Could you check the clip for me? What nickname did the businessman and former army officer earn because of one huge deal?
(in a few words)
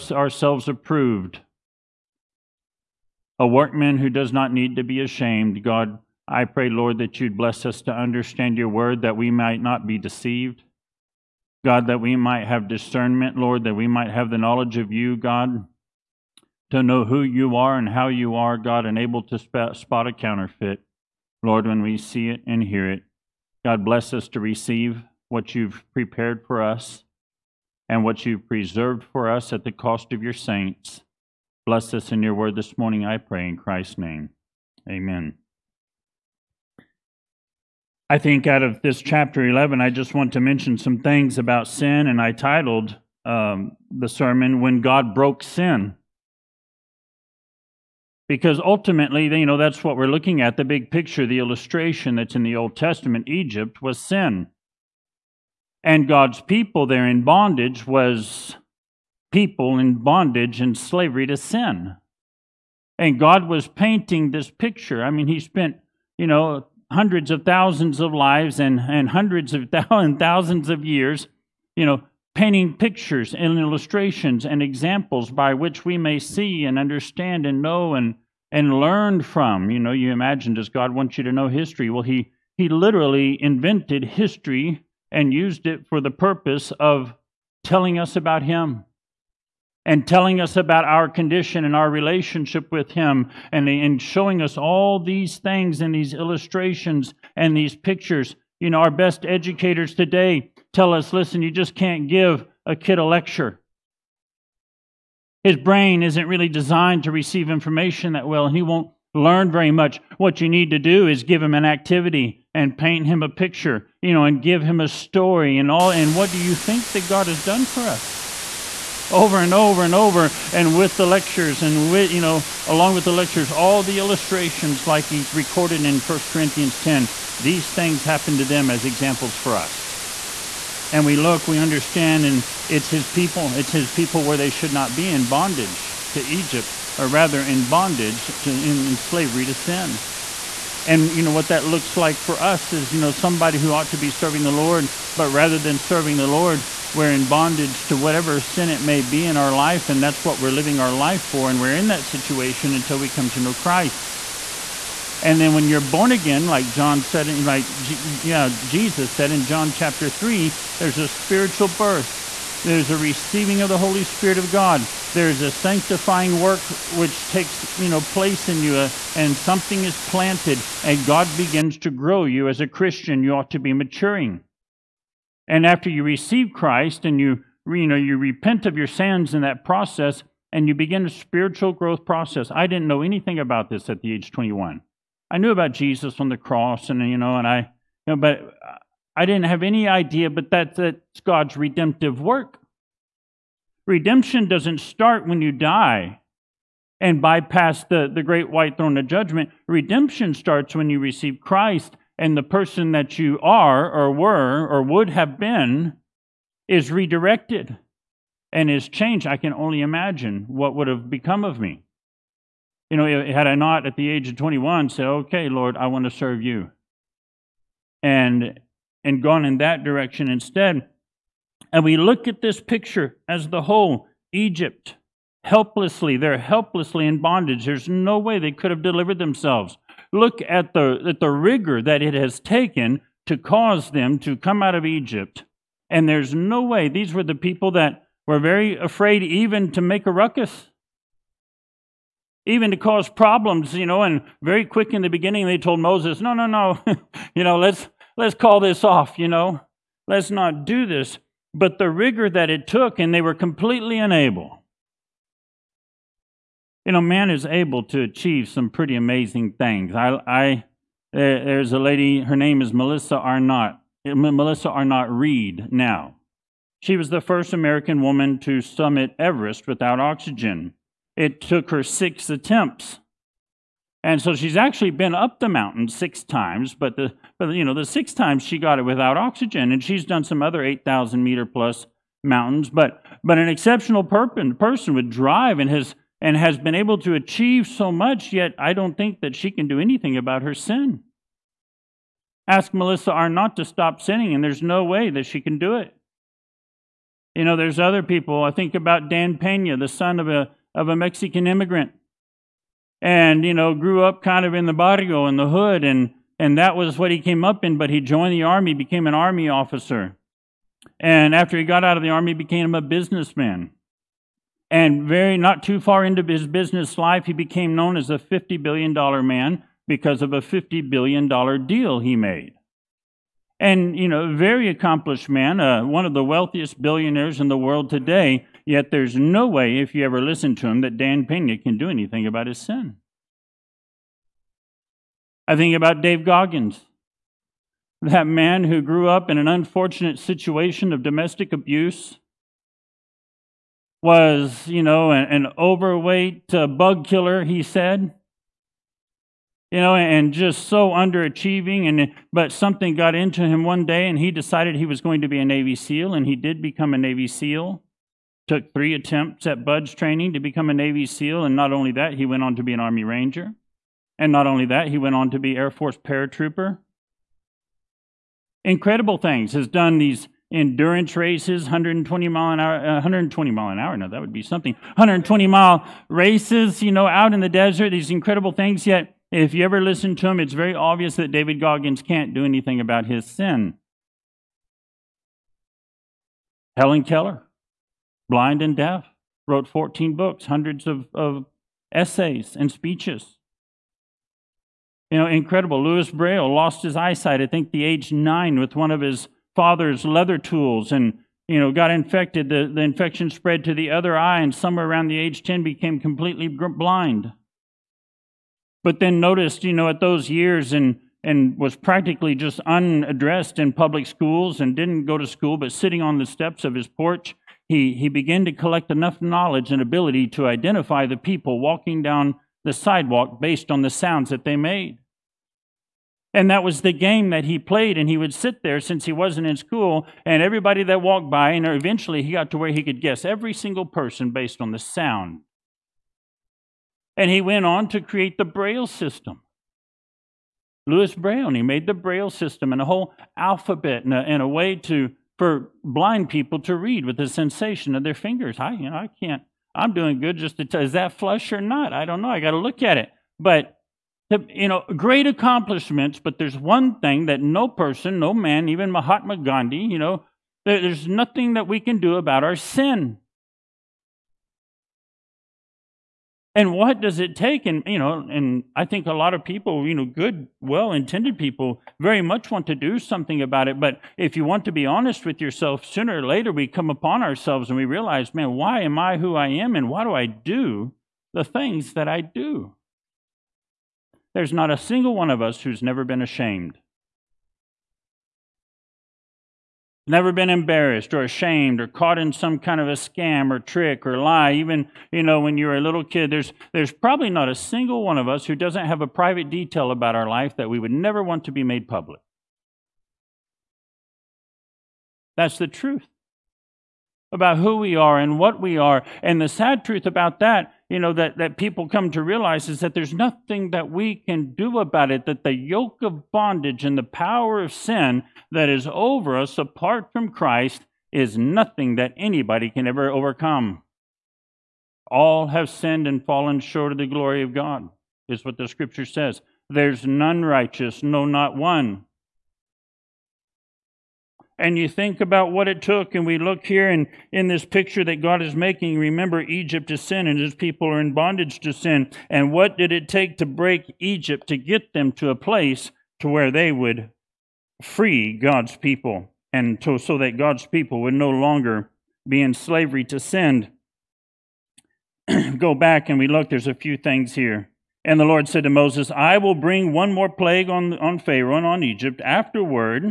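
$50 billion man.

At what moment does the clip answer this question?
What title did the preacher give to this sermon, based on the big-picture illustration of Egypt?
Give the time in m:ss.
0:44.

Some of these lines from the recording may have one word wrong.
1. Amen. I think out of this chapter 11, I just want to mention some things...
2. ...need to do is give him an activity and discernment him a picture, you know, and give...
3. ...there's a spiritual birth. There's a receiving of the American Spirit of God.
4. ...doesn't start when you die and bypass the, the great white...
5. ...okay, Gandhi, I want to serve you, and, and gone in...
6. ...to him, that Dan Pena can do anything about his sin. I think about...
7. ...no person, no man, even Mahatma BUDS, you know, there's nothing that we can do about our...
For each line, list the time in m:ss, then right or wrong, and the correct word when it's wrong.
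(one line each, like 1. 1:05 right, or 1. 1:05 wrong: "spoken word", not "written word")
1. 0:34 right
2. 1:50 wrong: "paint", not "discernment"
3. 2:40 wrong: "Holy", not "American"
4. 3:14 right
5. 3:35 wrong: "Lord", not "Gandhi"
6. 5:30 right
7. 7:37 wrong: "Gandhi", not "BUDS".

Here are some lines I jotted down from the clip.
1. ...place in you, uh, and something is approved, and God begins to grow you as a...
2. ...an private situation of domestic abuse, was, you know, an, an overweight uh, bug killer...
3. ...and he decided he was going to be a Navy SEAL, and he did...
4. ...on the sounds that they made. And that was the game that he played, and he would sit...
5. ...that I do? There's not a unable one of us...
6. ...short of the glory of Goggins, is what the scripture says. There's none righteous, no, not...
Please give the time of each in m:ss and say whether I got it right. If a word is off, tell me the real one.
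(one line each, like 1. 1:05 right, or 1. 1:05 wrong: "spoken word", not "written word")
1. 2:48 wrong: "planted", not "approved"
2. 5:39 wrong: "unfortunate", not "private"
3. 5:54 right
4. 7:03 right
5. 8:01 wrong: "single", not "unable"
6. 8:46 wrong: "God", not "Goggins".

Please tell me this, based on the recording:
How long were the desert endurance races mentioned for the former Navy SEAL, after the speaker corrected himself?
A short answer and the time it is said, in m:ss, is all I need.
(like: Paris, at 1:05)
120 miles, at 6:14.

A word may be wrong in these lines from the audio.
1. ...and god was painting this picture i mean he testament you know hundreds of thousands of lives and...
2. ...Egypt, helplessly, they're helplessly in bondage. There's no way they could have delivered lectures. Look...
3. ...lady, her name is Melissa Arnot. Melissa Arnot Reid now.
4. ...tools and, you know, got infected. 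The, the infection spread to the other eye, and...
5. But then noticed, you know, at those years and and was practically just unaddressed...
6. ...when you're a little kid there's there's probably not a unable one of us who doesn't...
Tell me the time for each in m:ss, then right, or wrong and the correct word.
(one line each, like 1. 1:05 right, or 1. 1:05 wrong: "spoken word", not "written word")
1. 1:02 wrong: "spent", not "testament"
2. 3:44 wrong: "themselves", not "lectures"
3. 4:21 right
4. 6:40 right
5. 6:48 right
6. 8:15 wrong: "single", not "unable".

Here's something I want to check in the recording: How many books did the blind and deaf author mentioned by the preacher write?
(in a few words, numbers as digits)
14.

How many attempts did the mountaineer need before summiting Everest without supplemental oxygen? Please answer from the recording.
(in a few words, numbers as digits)
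six attempts.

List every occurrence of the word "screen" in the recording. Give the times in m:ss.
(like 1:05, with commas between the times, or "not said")
not said.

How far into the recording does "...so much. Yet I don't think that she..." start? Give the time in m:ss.
4:47.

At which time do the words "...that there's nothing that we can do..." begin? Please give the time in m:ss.
8:32.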